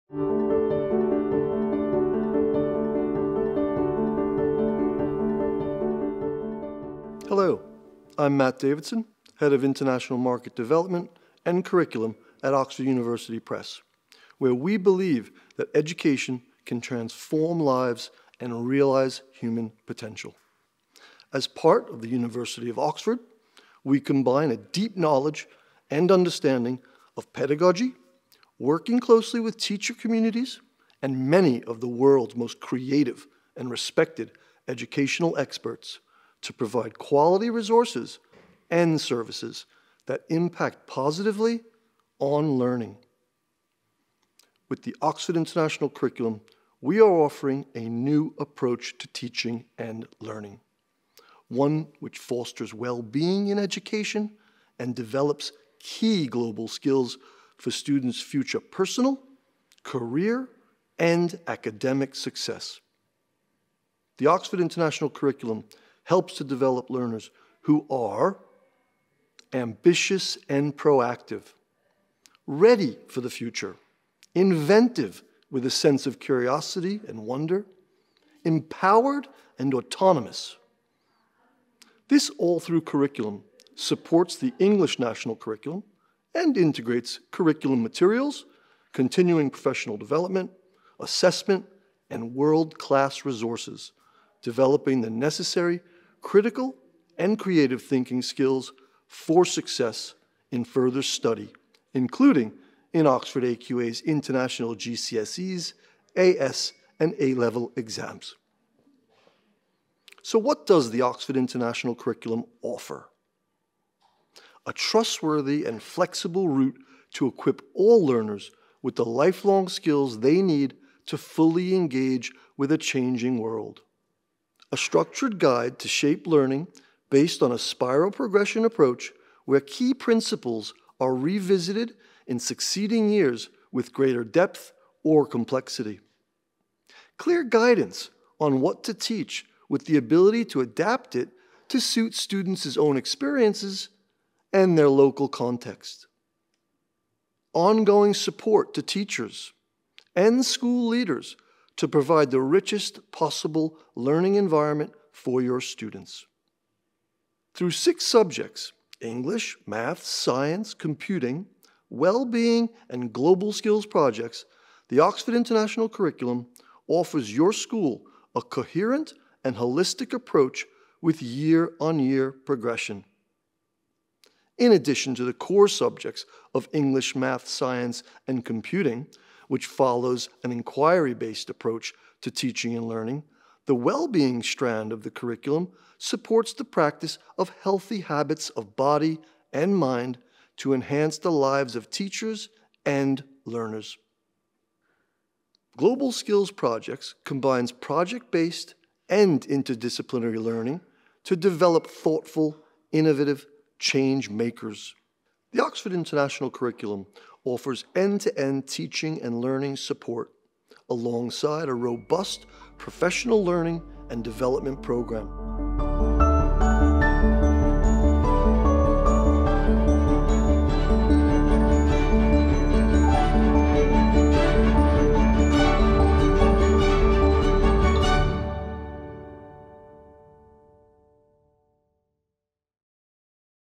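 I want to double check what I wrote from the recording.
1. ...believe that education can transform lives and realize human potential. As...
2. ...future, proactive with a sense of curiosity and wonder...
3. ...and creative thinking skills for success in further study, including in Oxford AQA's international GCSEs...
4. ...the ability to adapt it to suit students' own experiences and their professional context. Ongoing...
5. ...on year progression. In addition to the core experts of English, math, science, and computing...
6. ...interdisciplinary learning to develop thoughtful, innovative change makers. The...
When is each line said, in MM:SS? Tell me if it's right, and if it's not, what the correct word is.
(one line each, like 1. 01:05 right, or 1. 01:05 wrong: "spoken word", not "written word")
1. 00:14 right
2. 01:13 wrong: "inventive", not "proactive"
3. 01:37 right
4. 02:19 wrong: "local", not "professional"
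5. 02:51 wrong: "subjects", not "experts"
6. 03:19 right.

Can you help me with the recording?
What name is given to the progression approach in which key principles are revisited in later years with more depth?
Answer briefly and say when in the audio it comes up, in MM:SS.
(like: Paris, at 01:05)
Spiral progression, at 02:07.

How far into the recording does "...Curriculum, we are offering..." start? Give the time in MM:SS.
00:45.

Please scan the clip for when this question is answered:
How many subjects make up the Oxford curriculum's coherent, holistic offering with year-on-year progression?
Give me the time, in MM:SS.
02:37.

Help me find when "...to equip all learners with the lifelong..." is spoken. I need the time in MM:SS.
01:57.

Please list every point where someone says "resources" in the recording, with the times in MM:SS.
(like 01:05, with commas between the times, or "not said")
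00:37, 01:33.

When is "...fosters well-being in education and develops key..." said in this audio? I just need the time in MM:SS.
00:52.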